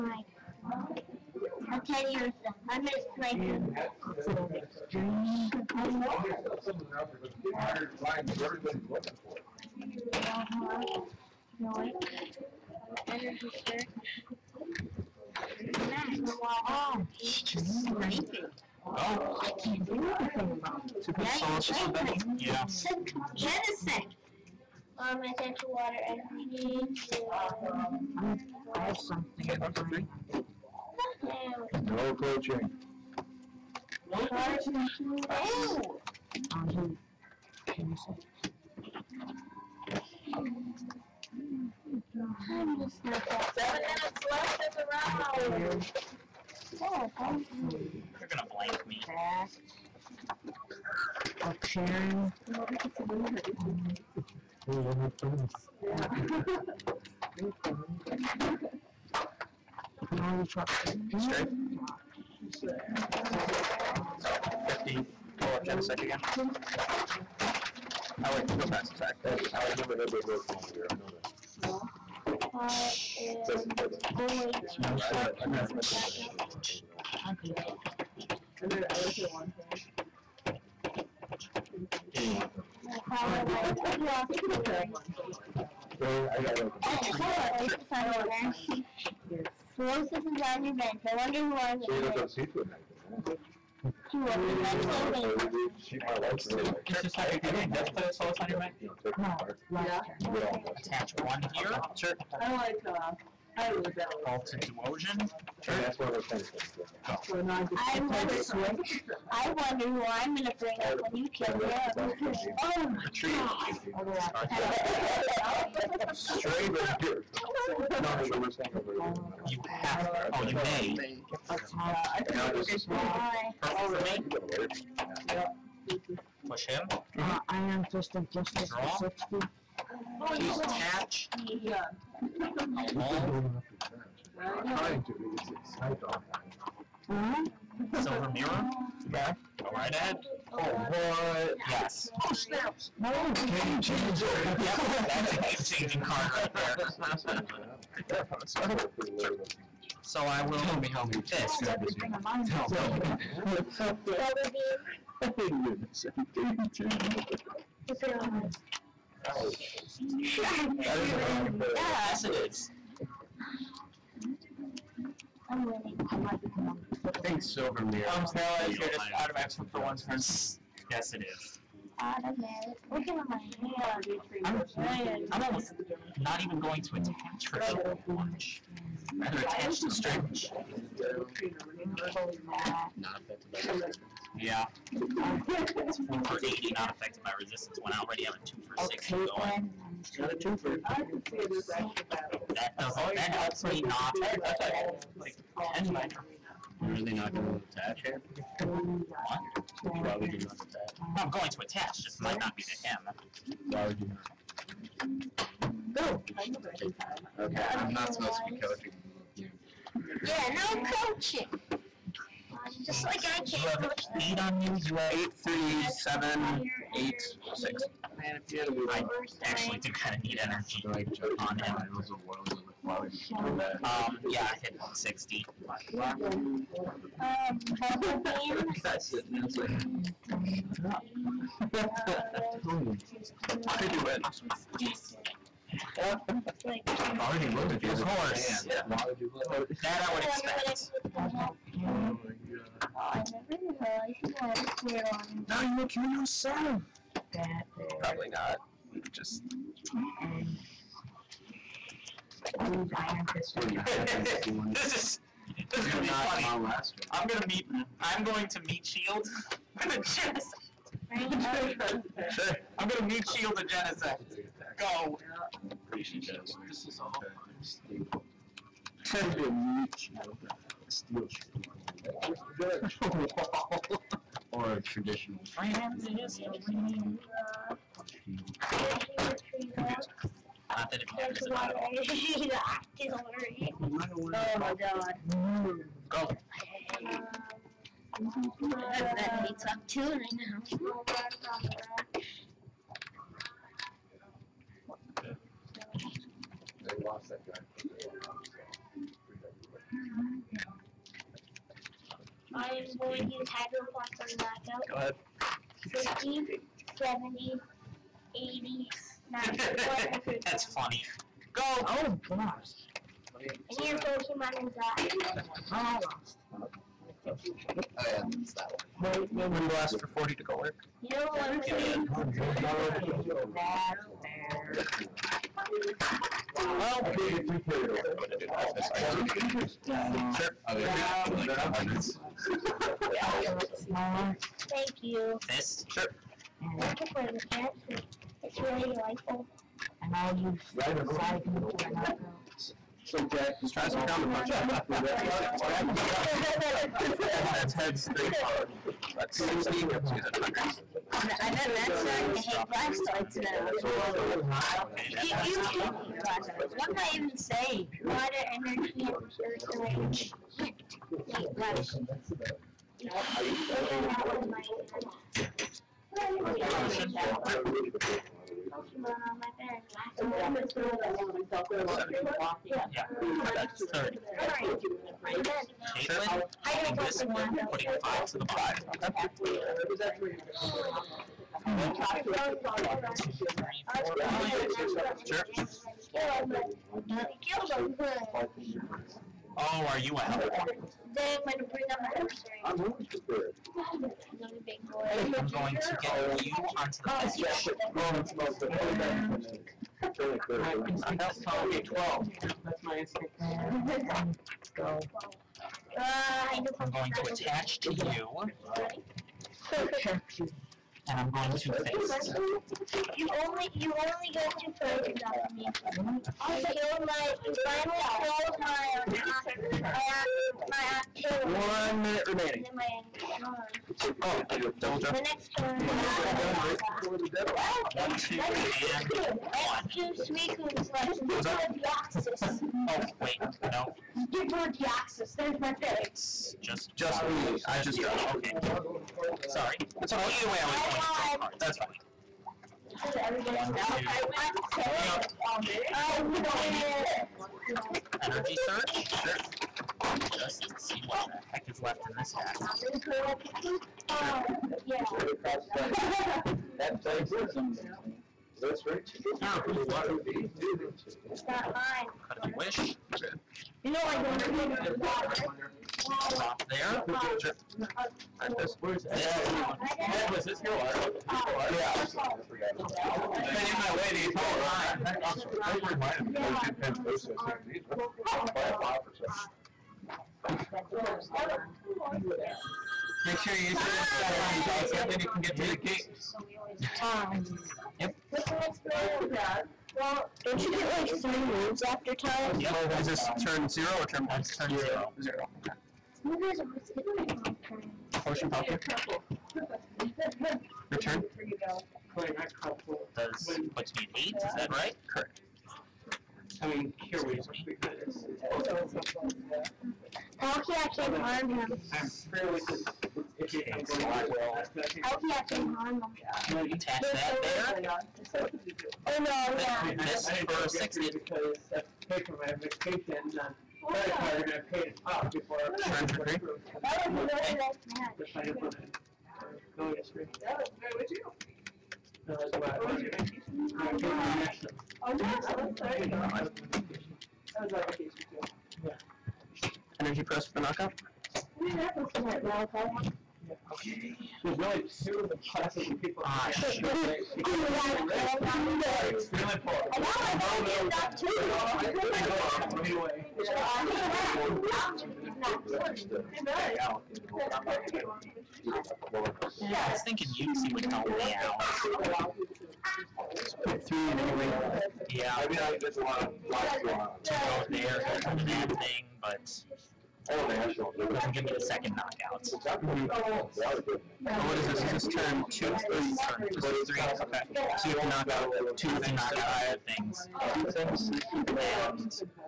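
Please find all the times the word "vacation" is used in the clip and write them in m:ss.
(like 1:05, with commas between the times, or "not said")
8:42, 8:57.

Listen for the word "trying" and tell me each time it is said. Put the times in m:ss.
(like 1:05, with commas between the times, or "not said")
2:14.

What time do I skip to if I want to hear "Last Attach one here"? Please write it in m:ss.
1:39.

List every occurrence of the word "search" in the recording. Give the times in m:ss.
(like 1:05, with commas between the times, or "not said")
0:13, 7:28.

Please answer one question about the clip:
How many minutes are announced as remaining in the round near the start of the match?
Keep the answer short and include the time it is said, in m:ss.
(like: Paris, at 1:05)
7, at 0:43.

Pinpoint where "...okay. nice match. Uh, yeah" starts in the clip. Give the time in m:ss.
8:47.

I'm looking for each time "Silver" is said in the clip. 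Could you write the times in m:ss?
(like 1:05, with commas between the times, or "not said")
2:18, 2:47.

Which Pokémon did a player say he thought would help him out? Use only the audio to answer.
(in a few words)
Uxie.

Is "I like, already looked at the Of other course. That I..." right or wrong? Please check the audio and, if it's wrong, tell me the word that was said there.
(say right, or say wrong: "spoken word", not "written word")
right.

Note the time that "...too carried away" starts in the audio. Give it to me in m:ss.
5:27.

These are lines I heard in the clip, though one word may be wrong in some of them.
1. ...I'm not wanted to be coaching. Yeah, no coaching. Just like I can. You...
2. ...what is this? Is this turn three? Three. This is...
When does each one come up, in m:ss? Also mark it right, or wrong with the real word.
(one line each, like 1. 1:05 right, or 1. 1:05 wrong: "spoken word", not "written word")
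1. 3:27 wrong: "supposed", not "wanted"
2. 9:34 wrong: "two", not "three".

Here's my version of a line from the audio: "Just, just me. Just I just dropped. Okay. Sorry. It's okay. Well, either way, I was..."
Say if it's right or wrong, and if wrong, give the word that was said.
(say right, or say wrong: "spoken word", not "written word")
right.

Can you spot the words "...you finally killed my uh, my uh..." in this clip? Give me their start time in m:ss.
6:57.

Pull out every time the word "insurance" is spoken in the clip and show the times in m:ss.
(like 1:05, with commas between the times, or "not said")
not said.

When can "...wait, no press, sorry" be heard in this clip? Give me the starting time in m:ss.
1:08.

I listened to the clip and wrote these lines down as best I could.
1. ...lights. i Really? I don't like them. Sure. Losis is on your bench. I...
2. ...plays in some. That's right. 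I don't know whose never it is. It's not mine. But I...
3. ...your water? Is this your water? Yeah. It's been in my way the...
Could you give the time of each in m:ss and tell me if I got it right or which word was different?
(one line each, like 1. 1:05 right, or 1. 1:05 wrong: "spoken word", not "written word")
1. 1:23 right
2. 7:37 wrong: "water", not "never"
3. 7:50 right.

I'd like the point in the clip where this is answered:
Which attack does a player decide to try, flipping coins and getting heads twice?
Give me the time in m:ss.
5:44.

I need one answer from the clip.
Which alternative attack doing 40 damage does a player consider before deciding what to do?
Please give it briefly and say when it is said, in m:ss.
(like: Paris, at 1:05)
Wind Blast, at 5:19.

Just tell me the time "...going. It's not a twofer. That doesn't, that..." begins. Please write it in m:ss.
3:09.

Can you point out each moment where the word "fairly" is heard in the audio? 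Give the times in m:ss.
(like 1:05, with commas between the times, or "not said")
8:32.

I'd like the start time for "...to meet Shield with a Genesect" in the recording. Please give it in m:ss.
4:18.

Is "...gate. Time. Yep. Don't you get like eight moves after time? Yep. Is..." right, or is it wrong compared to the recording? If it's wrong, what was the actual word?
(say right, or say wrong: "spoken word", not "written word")
wrong: "three", not "eight".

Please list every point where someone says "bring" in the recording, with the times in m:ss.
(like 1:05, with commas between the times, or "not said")
1:50, 6:31.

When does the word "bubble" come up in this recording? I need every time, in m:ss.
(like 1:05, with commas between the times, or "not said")
2:33, 3:47.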